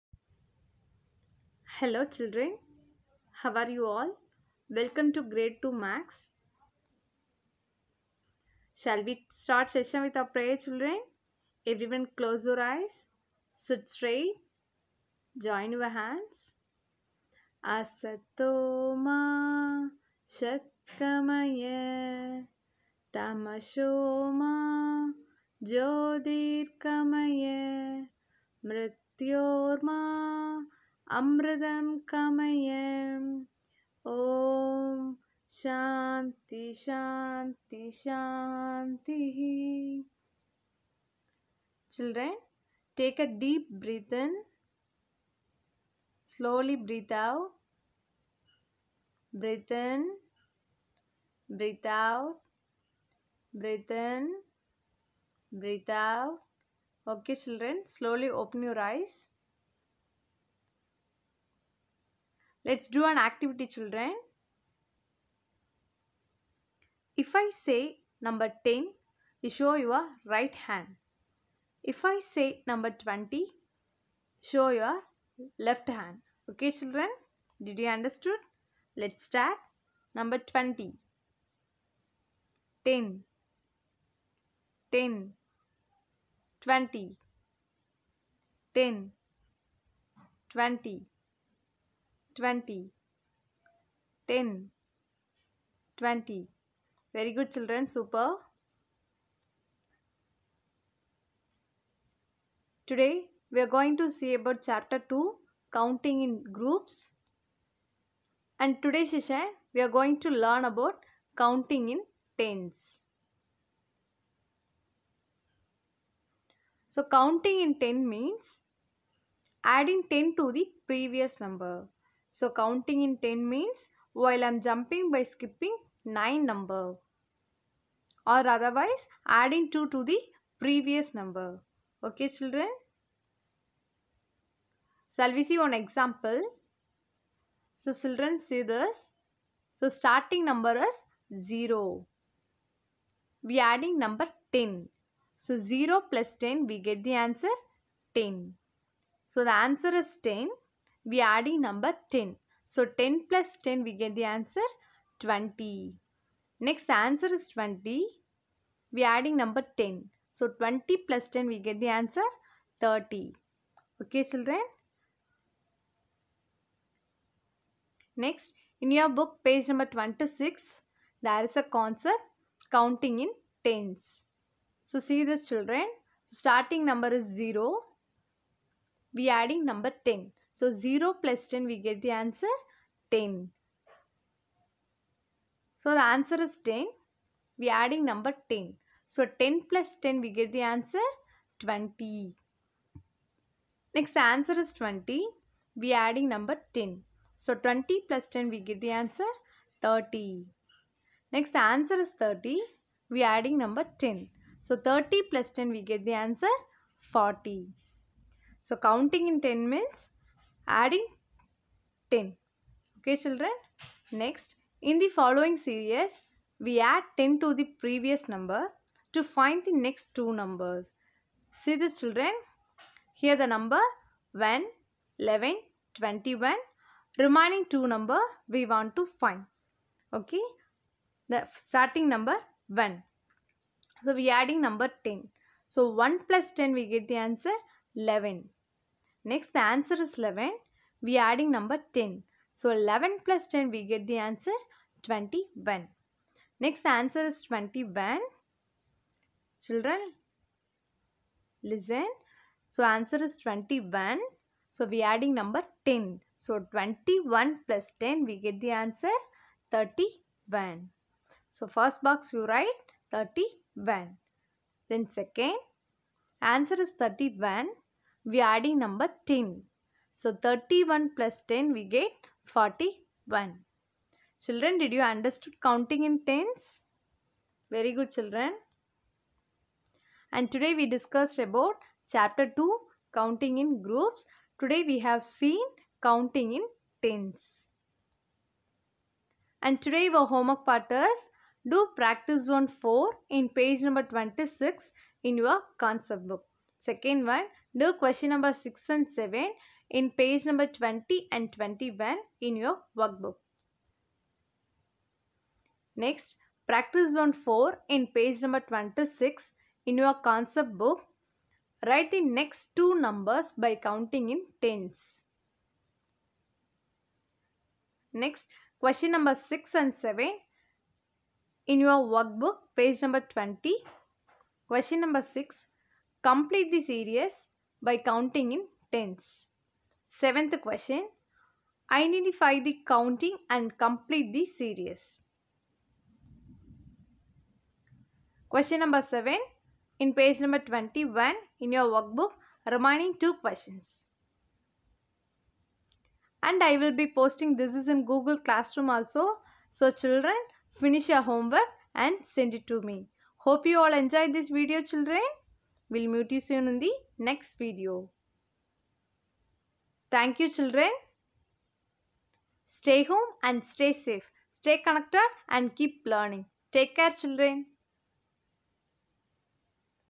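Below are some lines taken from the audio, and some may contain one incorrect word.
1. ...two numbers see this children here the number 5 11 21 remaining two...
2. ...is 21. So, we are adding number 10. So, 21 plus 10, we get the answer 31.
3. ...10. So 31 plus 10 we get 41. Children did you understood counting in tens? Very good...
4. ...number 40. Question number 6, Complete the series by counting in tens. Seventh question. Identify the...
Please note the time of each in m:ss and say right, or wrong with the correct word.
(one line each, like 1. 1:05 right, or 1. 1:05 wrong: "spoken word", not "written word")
1. 3:40 wrong: "1", not "5"
2. 4:13 right
3. 4:29 right
4. 5:23 wrong: "20", not "40".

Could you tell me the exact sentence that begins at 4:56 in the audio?
Second one, do question number 6 and 7 in page number 20 and 21 in your workbook.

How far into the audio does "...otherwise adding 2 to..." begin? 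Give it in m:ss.
2:08.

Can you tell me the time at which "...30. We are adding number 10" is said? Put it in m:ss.
3:22.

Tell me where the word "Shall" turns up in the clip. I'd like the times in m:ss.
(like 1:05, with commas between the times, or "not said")
0:08, 2:15.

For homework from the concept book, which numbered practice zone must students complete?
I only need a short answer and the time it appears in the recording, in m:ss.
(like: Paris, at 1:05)
practice zone 4, at 4:51.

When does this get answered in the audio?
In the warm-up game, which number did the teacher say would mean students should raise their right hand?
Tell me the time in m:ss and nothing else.
1:07.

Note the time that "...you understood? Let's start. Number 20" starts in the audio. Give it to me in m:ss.
1:17.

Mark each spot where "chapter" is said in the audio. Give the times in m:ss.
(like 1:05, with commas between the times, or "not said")
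1:44, 4:42.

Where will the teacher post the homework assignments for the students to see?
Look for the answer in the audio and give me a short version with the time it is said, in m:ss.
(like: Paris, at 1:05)
Google Classroom, at 5:48.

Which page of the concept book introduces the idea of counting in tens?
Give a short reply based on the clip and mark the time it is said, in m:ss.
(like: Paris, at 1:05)
26, at 2:49.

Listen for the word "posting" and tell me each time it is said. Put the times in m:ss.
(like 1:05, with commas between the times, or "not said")
5:47.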